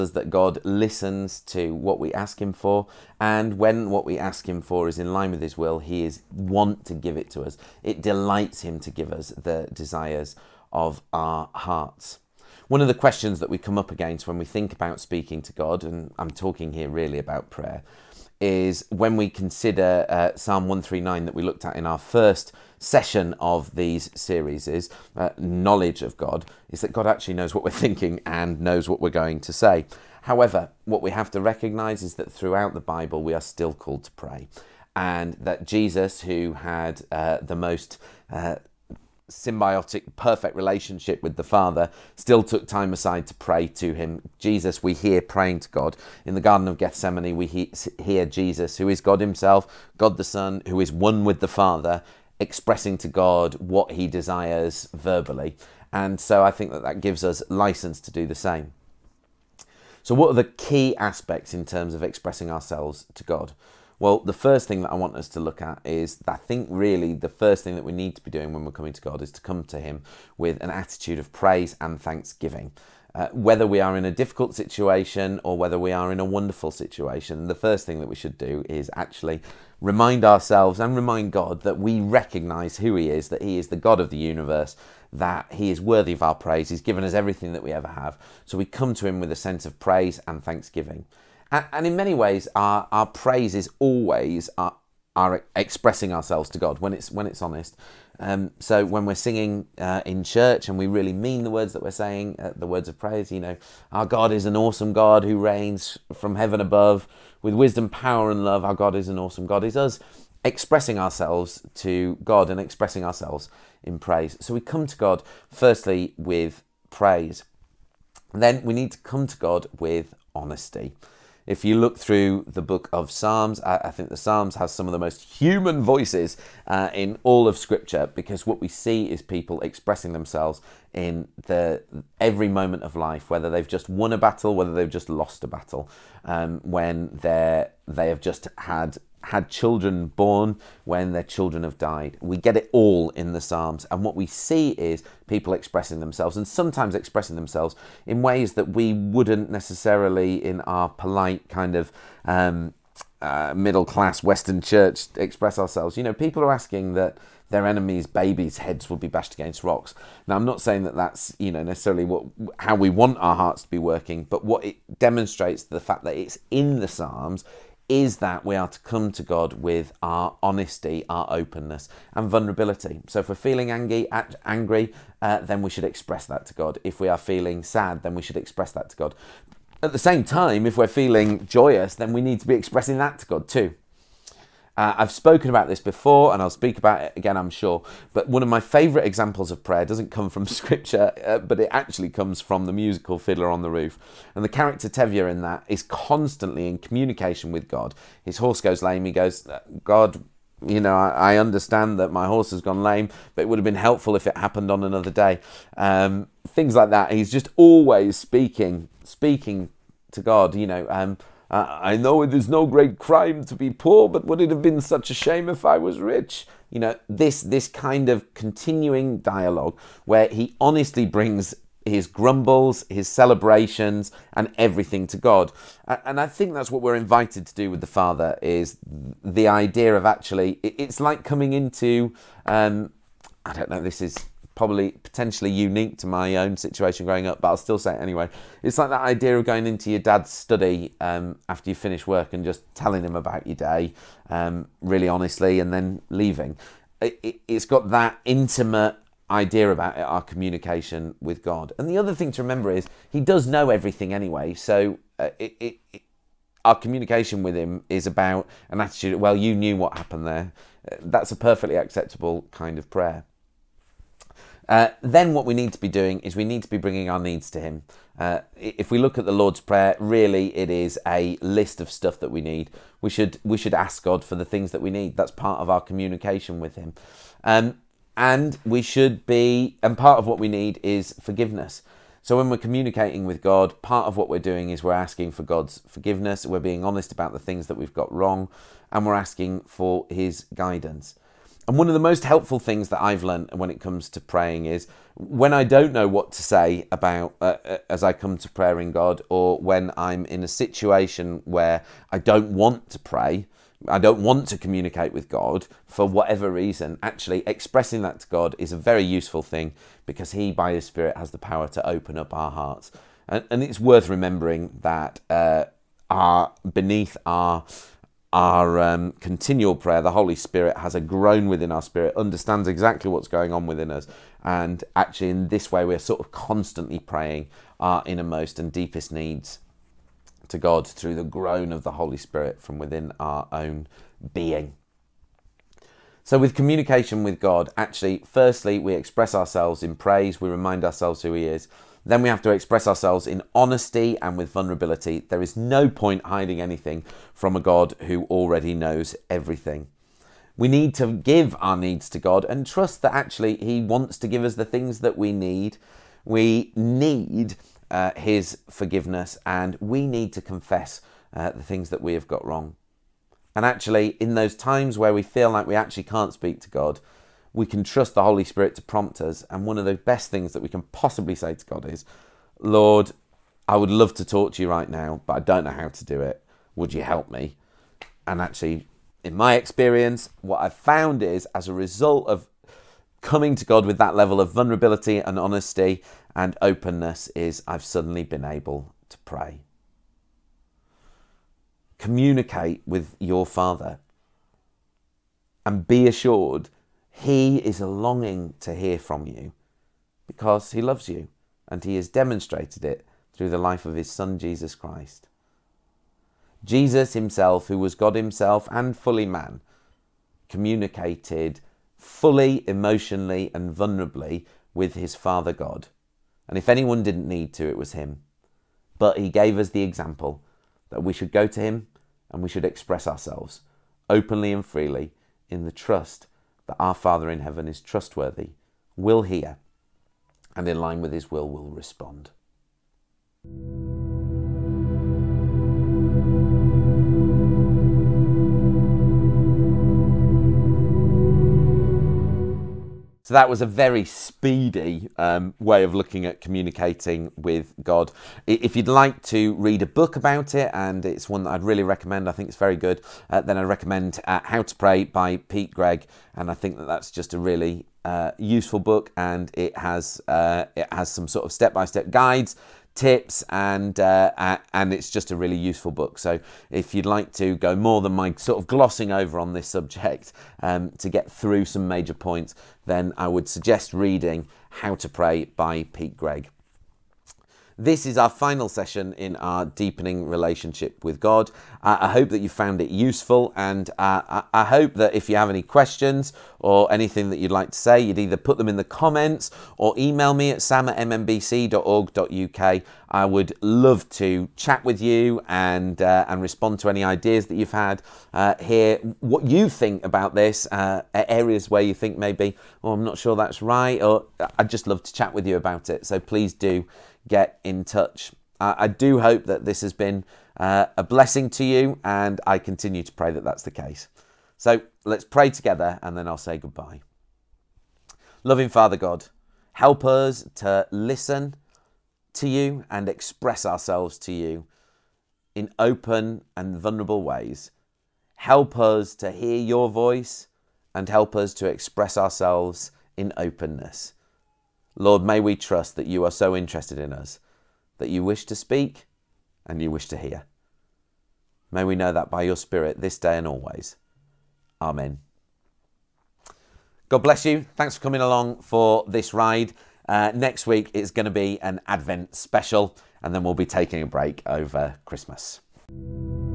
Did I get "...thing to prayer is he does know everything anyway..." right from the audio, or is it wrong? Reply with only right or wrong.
wrong.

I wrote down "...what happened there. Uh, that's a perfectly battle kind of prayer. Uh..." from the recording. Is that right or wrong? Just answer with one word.
wrong.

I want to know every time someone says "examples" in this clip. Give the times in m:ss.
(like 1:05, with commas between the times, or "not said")
3:09, 6:59.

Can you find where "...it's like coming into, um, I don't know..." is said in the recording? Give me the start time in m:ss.
3:50.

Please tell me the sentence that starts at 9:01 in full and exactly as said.
May we know that by your Spirit this day and always.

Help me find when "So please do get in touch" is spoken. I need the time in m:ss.
8:26.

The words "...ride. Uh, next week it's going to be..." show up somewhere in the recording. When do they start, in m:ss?
9:09.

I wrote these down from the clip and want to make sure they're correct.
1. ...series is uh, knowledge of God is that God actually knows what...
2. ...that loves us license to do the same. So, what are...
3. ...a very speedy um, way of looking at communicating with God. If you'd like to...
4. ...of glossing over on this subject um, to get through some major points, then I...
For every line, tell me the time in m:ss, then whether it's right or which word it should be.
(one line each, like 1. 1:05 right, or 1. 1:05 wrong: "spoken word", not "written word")
1. 0:24 right
2. 0:56 wrong: "gives", not "loves"
3. 7:23 right
4. 7:48 right.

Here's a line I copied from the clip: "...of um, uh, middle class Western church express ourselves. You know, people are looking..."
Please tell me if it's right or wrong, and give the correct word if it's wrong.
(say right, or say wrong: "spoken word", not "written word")
wrong: "asking", not "looking".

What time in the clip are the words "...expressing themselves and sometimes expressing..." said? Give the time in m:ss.
2:25.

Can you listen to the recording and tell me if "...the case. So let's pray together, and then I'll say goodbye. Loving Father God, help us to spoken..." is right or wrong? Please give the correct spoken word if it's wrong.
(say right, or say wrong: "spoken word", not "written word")
wrong: "listen", not "spoken".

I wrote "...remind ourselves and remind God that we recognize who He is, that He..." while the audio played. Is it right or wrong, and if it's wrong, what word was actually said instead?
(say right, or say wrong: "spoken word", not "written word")
right.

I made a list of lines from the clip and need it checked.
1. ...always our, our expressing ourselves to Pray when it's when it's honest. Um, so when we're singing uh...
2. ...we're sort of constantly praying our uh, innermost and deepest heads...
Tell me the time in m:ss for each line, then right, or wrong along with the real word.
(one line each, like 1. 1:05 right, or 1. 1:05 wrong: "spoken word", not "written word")
1. 1:33 wrong: "God", not "Pray"
2. 5:25 wrong: "needs", not "heads".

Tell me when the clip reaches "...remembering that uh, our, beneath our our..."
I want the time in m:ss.
5:14.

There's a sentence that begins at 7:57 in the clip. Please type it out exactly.
This is our final session in our deepening relationship with God.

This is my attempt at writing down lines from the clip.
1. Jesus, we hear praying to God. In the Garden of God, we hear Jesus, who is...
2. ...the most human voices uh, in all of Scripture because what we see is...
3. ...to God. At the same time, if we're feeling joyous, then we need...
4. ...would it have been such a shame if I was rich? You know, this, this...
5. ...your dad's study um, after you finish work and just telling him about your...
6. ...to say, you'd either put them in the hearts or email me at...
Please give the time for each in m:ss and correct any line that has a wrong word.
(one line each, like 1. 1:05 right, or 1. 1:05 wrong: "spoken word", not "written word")
1. 0:44 wrong: "Gethsemane", not "God"
2. 2:04 right
3. 2:58 right
4. 3:34 right
5. 3:59 right
6. 8:07 wrong: "comments", not "hearts".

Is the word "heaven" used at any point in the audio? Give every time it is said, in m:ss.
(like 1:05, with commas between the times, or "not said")
1:46, 7:07.